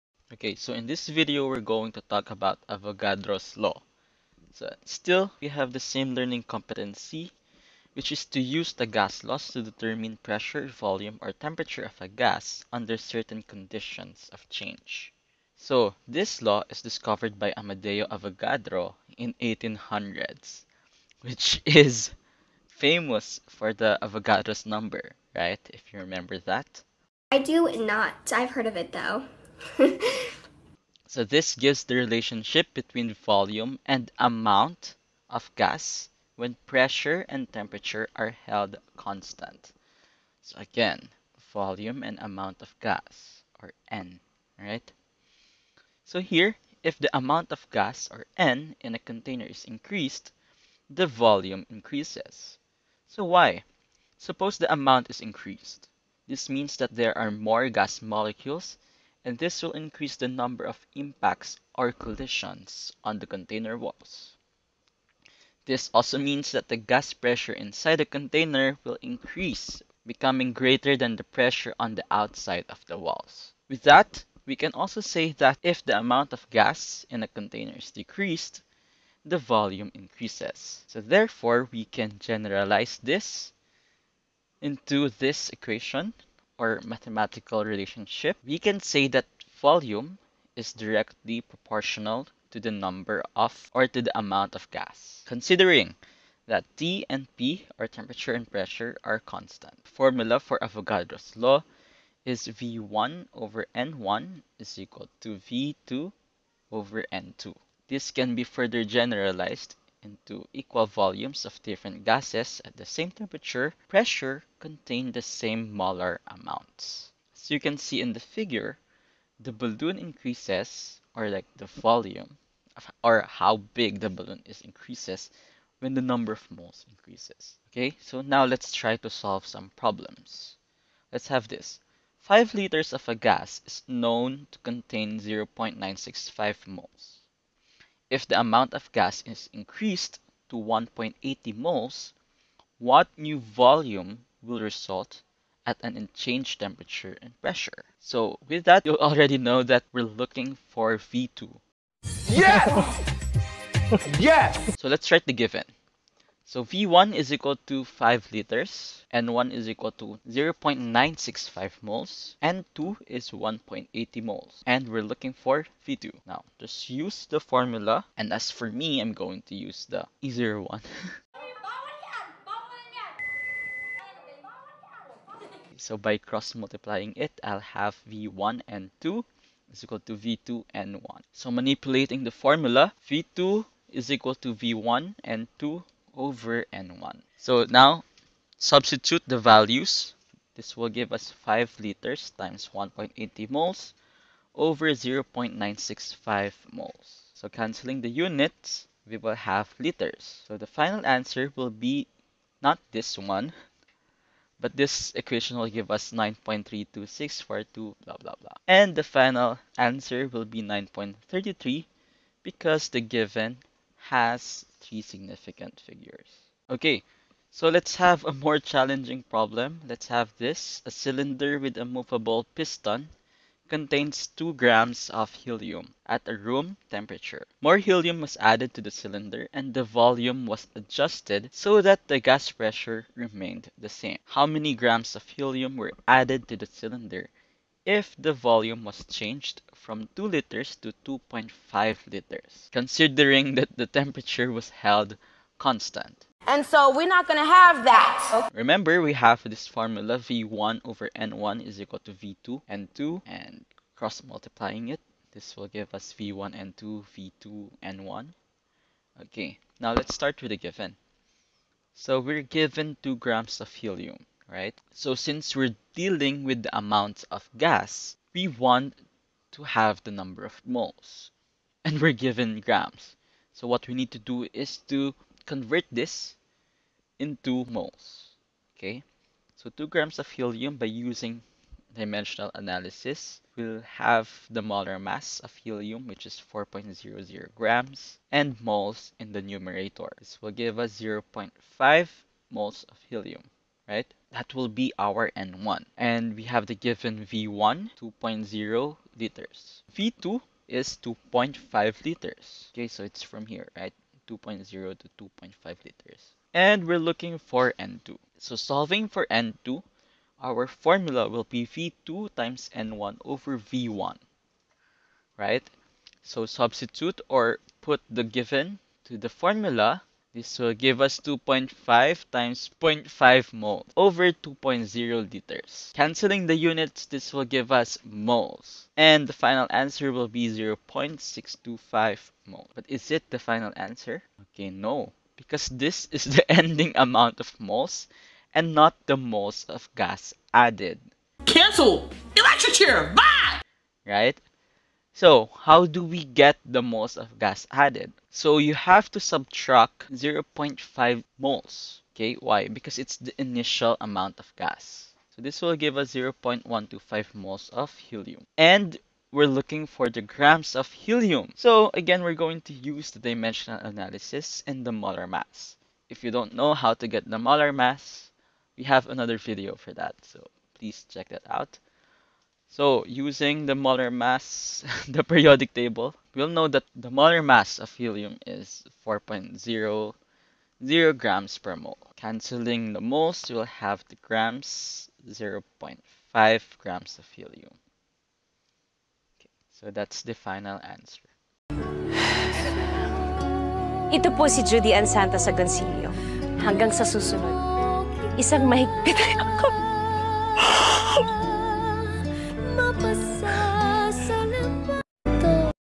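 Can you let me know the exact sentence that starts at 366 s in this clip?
If you don't know how to get the molar mass, we have another video for that.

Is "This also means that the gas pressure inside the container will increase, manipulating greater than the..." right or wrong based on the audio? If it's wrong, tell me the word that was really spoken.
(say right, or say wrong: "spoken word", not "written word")
wrong: "becoming", not "manipulating".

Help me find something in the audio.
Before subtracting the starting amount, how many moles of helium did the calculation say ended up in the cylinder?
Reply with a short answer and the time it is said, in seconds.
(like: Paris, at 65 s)
0.625 mole, at 330 s.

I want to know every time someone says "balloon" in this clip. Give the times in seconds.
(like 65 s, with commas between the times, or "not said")
119 s, 124 s.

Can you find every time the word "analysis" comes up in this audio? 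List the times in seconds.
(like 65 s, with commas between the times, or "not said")
282 s, 363 s.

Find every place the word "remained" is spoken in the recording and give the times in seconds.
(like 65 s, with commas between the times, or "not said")
233 s.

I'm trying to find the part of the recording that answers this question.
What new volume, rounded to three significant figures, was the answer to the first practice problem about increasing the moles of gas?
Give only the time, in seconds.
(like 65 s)
210 s.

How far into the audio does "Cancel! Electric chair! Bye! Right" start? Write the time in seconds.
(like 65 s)
341 s.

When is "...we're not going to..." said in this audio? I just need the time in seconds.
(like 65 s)
246 s.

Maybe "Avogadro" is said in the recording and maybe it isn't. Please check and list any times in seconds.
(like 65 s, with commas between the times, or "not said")
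2 s, 18 s, 24 s, 100 s.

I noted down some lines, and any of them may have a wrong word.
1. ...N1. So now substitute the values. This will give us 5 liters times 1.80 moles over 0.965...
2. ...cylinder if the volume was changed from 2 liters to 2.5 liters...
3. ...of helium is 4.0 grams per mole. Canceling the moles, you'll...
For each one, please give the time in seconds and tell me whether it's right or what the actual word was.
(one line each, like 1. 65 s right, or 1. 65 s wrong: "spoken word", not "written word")
1. 186 s right
2. 236 s right
3. 377 s right.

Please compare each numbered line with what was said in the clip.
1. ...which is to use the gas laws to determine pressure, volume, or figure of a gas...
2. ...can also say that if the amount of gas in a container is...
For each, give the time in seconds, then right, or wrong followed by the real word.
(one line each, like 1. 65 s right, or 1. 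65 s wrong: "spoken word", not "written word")
1. 7 s wrong: "temperature", not "figure"
2. 74 s right.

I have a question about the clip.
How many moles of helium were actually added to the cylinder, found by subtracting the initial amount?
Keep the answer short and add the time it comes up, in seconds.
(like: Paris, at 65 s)
0.125 moles, at 356 s.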